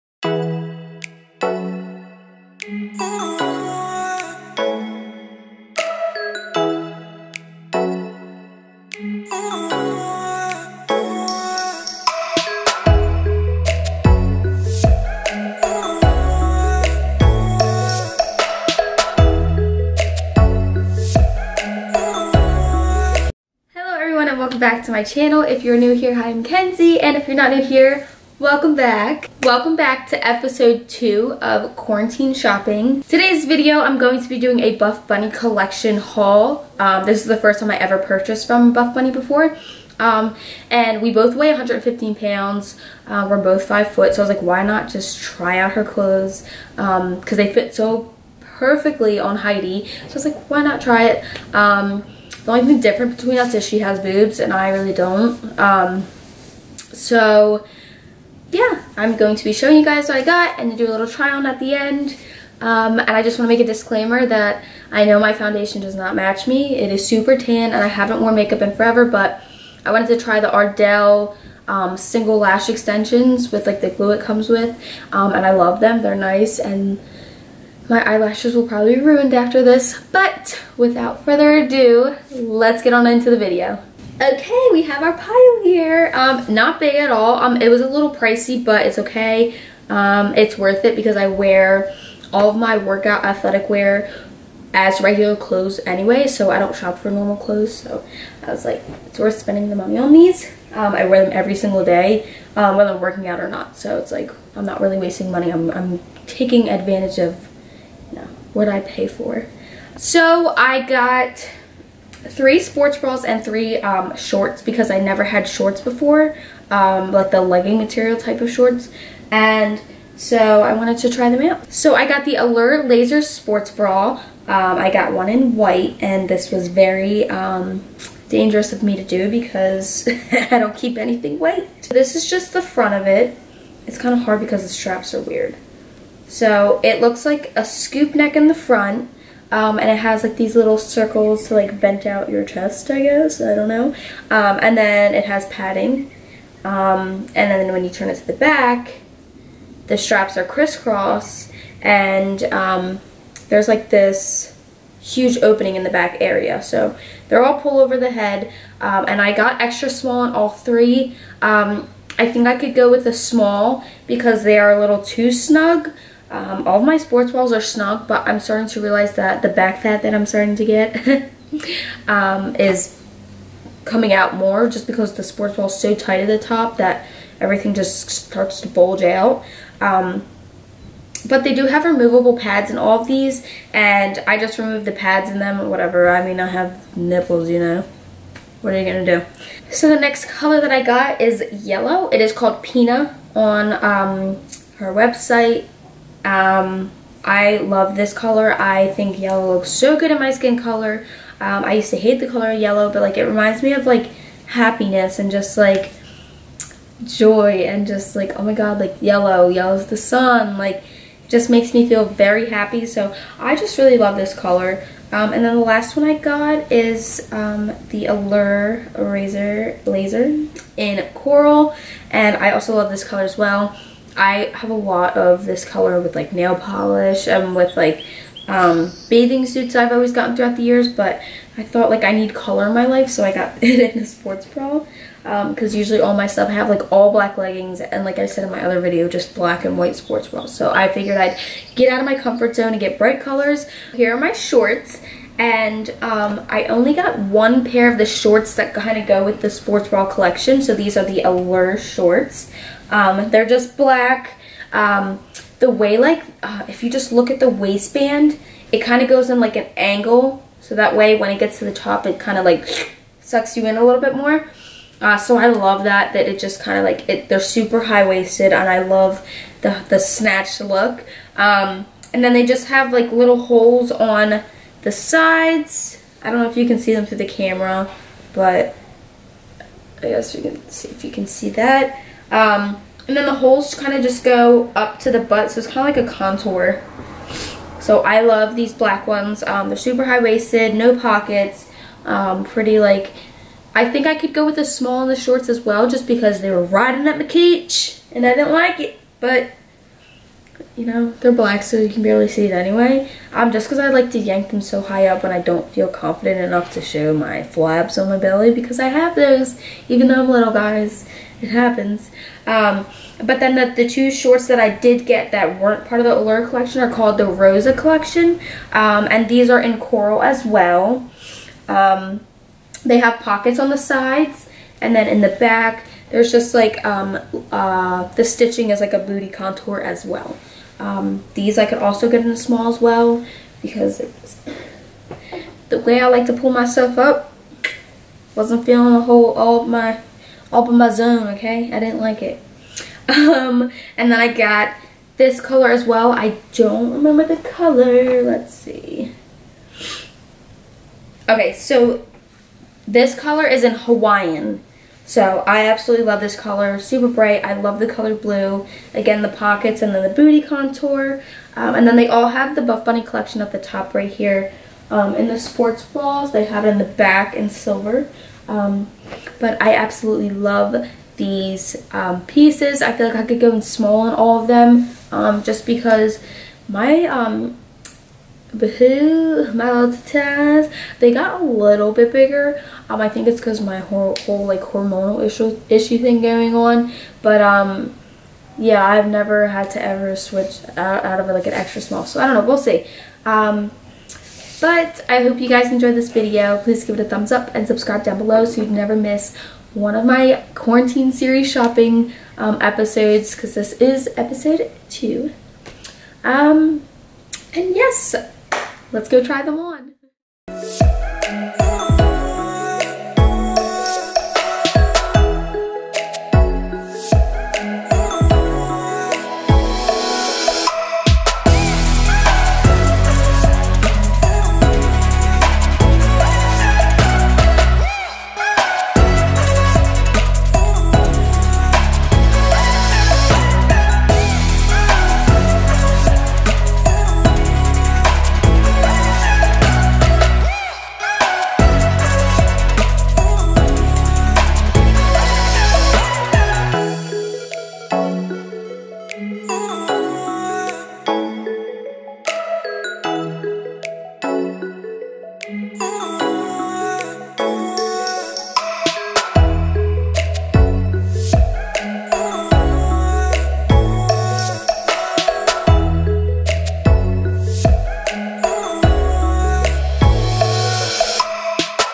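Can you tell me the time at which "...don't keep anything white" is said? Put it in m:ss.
2:10.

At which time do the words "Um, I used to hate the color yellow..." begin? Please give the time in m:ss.
3:21.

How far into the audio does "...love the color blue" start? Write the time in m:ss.
5:57.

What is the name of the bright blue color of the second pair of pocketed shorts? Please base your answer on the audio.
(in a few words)
Hawaiian.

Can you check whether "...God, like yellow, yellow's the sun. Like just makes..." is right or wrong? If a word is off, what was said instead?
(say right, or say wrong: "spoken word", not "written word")
right.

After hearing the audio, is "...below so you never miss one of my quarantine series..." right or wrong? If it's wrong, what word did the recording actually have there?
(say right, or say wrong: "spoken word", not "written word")
right.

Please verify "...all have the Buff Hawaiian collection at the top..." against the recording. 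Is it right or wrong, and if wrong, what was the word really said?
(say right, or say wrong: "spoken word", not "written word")
wrong: "Bunny", not "Hawaiian".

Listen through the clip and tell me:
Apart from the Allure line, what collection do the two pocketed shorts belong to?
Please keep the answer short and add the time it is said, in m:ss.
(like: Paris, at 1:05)
Rosa, at 5:17.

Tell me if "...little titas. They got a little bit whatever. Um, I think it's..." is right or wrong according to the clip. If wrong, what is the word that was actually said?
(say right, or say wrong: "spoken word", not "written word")
wrong: "bigger", not "whatever".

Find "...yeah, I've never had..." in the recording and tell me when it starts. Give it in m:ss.
6:28.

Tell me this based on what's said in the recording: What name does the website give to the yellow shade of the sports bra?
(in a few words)
Pina.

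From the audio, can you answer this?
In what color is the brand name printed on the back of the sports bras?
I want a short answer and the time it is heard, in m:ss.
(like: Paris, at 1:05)
Silver, at 6:07.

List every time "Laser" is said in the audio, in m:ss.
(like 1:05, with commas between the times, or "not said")
2:02, 3:39.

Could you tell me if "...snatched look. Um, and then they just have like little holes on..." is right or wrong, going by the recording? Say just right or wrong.
right.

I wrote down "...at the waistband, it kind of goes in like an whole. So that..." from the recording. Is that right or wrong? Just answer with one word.
wrong.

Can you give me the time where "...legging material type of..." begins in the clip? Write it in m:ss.
1:57.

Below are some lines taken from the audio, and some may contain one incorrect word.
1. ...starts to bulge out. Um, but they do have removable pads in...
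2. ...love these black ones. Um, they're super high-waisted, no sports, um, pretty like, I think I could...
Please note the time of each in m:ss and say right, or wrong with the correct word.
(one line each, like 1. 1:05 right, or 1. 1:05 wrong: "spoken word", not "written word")
1. 2:58 right
2. 4:48 wrong: "pockets", not "sports".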